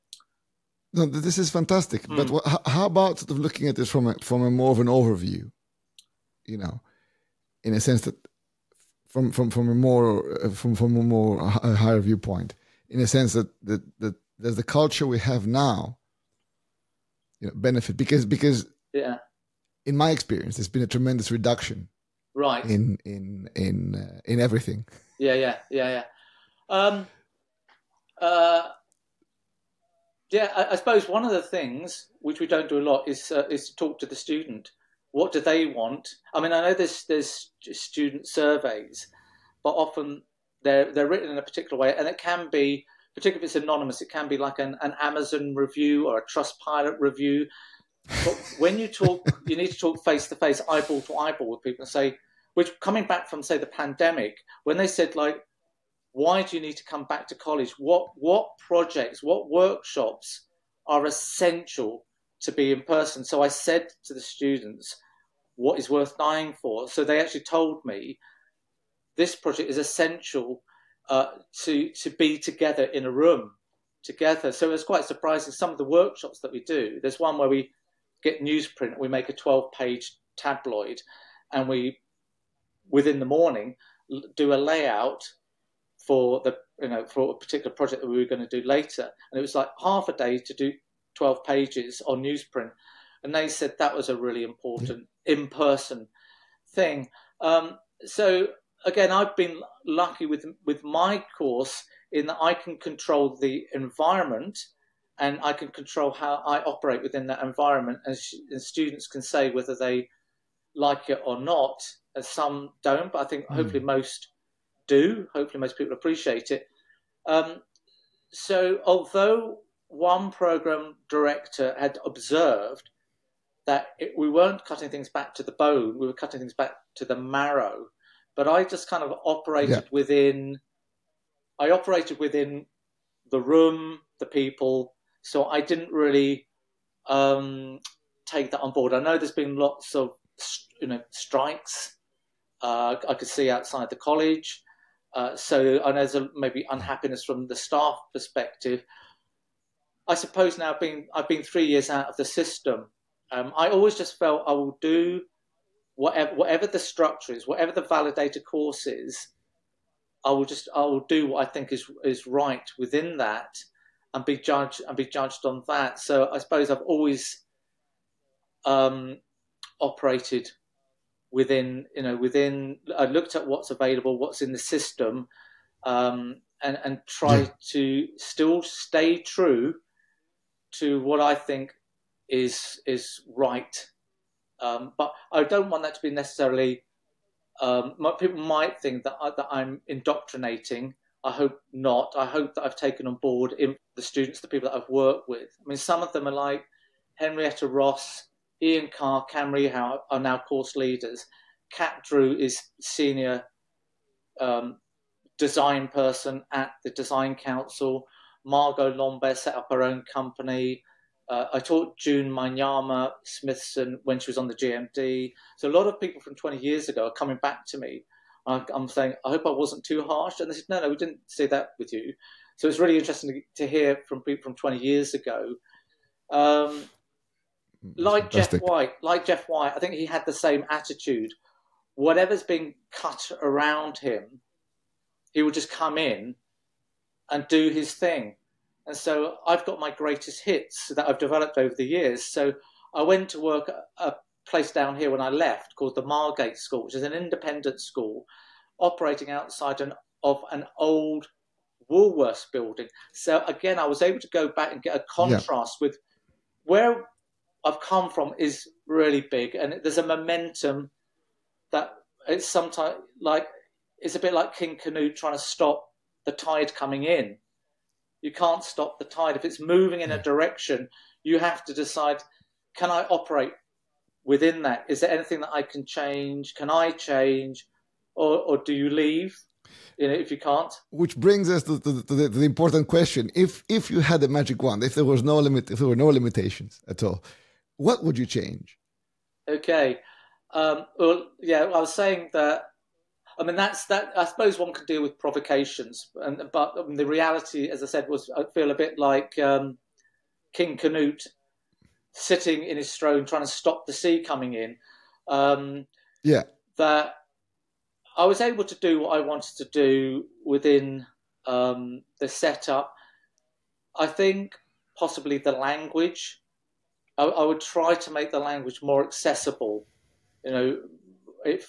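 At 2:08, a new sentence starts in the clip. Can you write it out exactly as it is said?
But I just kind of operated yeah.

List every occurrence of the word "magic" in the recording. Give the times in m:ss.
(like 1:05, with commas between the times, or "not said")
4:44.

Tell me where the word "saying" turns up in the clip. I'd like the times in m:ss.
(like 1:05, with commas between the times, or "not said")
3:38, 4:51.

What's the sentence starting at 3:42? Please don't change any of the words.
So it's really interesting to, hear from people from 20 years ago.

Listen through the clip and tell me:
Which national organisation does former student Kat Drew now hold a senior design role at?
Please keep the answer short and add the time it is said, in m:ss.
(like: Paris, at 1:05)
Design Council, at 3:26.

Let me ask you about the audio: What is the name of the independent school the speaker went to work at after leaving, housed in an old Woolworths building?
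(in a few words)
Margate School.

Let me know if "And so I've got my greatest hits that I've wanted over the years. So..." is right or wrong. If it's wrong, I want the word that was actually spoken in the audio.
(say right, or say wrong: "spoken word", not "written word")
wrong: "developed", not "wanted".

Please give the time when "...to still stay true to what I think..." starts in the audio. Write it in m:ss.
2:57.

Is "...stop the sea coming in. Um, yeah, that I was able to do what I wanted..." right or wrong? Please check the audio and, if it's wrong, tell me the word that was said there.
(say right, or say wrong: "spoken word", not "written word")
right.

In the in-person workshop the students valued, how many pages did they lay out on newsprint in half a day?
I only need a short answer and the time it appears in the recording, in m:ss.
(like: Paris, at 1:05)
12, at 1:19.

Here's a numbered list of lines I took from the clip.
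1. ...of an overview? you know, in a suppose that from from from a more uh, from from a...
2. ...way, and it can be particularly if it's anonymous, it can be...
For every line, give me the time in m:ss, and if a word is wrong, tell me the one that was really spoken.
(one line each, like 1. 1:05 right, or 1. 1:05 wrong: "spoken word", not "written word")
1. 0:04 wrong: "sense", not "suppose"
2. 0:41 right.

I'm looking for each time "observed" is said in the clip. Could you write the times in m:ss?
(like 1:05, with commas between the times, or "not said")
2:02.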